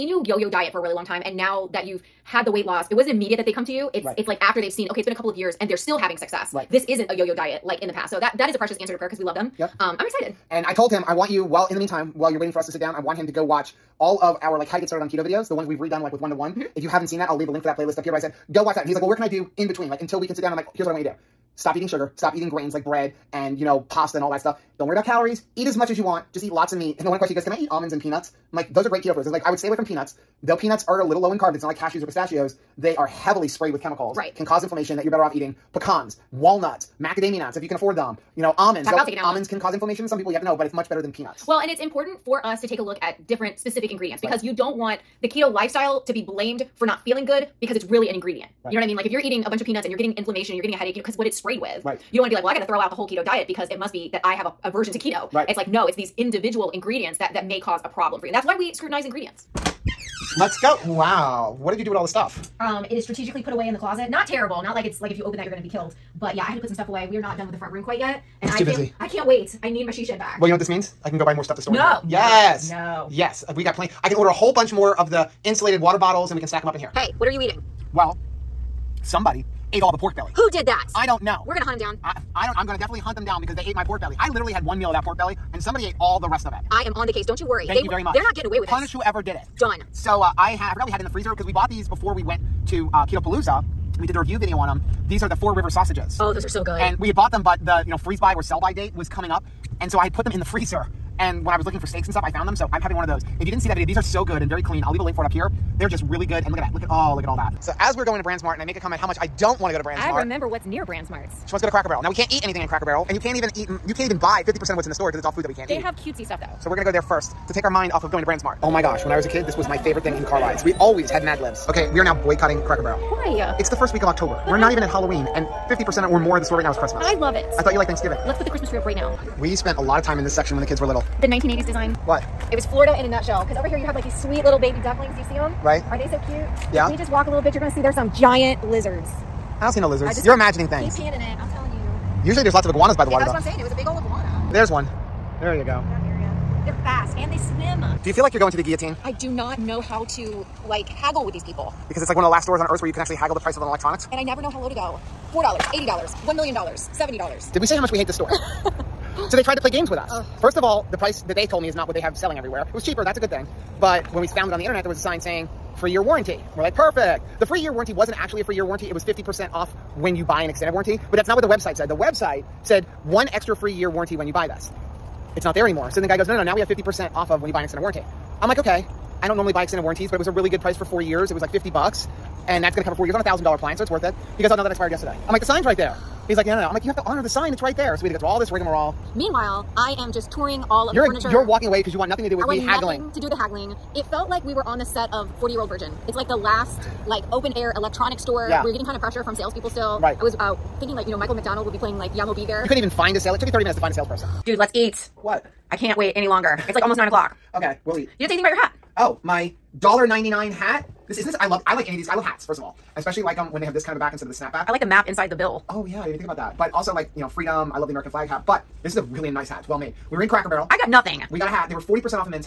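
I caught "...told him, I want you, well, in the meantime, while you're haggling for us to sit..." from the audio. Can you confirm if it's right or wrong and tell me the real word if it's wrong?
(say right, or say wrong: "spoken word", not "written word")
wrong: "waiting", not "haggling".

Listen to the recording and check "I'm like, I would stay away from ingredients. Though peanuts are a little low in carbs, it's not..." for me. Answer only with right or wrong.
wrong.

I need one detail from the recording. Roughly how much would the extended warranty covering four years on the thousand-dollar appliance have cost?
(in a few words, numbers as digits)
$50.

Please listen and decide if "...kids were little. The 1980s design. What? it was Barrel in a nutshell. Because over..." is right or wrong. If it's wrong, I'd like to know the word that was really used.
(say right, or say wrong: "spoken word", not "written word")
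wrong: "Florida", not "Barrel".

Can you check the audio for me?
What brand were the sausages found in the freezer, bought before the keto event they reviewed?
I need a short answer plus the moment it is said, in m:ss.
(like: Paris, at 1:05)
Four River, at 1:35.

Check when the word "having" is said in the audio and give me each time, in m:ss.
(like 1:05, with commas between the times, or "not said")
0:05, 1:42.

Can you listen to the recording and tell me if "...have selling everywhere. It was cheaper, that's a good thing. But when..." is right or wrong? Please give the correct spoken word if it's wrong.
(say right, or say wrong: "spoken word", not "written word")
right.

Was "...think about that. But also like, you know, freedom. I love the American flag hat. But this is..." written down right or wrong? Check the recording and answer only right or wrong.
right.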